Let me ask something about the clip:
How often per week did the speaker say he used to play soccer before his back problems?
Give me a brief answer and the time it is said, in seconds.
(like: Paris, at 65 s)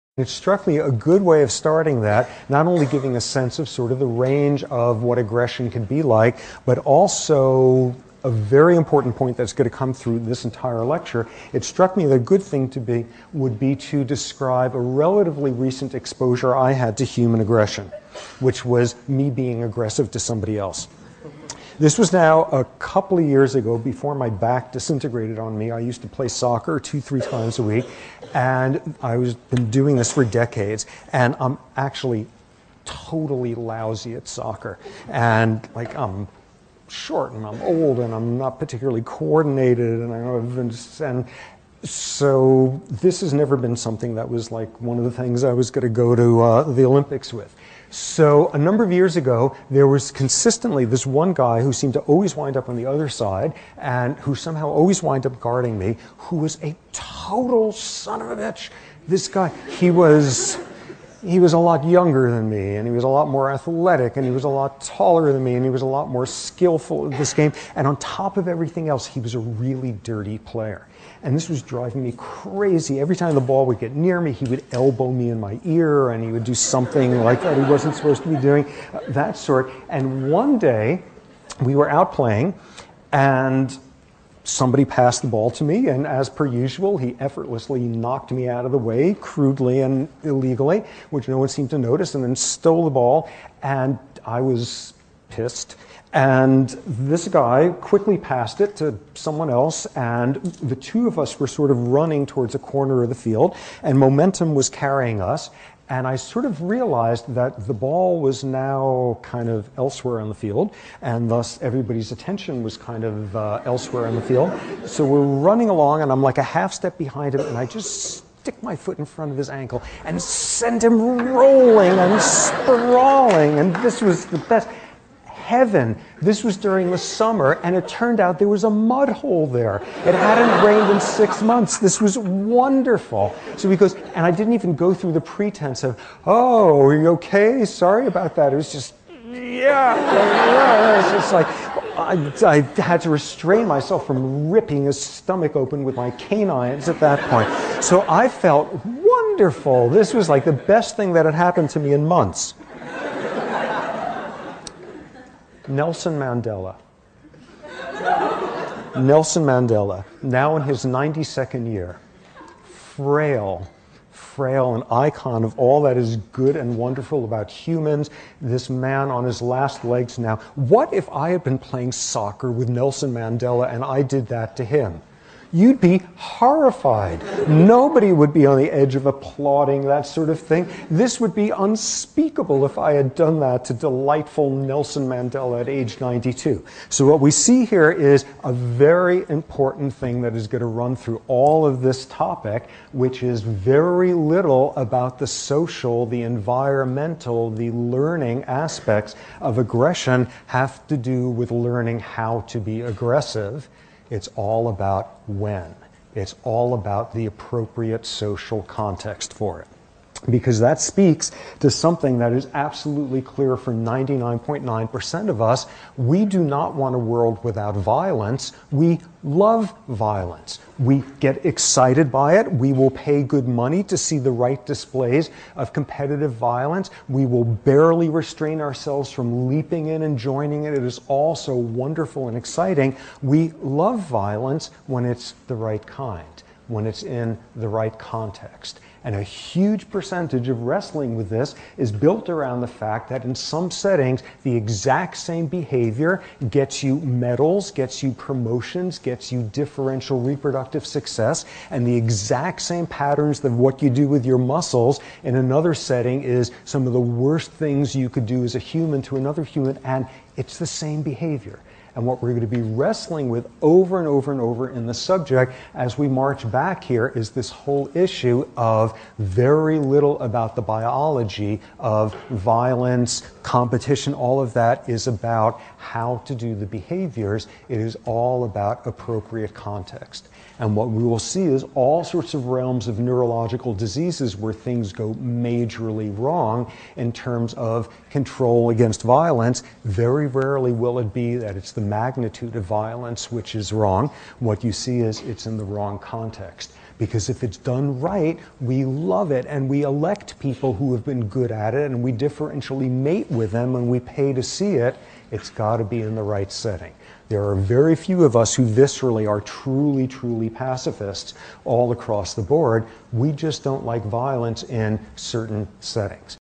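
2-3 times a week, at 26 s.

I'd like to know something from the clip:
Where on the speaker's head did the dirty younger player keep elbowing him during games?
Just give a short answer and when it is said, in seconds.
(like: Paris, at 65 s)
Ear, at 75 s.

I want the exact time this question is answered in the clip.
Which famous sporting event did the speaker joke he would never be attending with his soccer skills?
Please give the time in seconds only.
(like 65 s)
46 s.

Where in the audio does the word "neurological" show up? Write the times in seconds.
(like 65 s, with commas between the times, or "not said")
282 s.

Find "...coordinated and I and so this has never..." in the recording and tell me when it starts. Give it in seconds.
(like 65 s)
39 s.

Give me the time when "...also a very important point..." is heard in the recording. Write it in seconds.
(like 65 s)
6 s.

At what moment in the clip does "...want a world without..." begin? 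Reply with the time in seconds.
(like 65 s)
216 s.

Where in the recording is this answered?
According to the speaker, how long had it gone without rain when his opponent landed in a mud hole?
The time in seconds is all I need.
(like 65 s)
131 s.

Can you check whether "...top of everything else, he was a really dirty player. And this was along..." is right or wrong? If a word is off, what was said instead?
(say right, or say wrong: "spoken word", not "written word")
wrong: "driving", not "along".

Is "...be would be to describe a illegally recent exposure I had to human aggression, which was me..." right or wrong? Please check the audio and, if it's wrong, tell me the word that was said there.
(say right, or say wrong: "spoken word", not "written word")
wrong: "relatively", not "illegally".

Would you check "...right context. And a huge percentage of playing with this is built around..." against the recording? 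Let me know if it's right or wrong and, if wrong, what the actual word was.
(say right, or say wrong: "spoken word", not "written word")
wrong: "wrestling", not "playing".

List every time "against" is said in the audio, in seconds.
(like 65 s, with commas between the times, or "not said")
288 s.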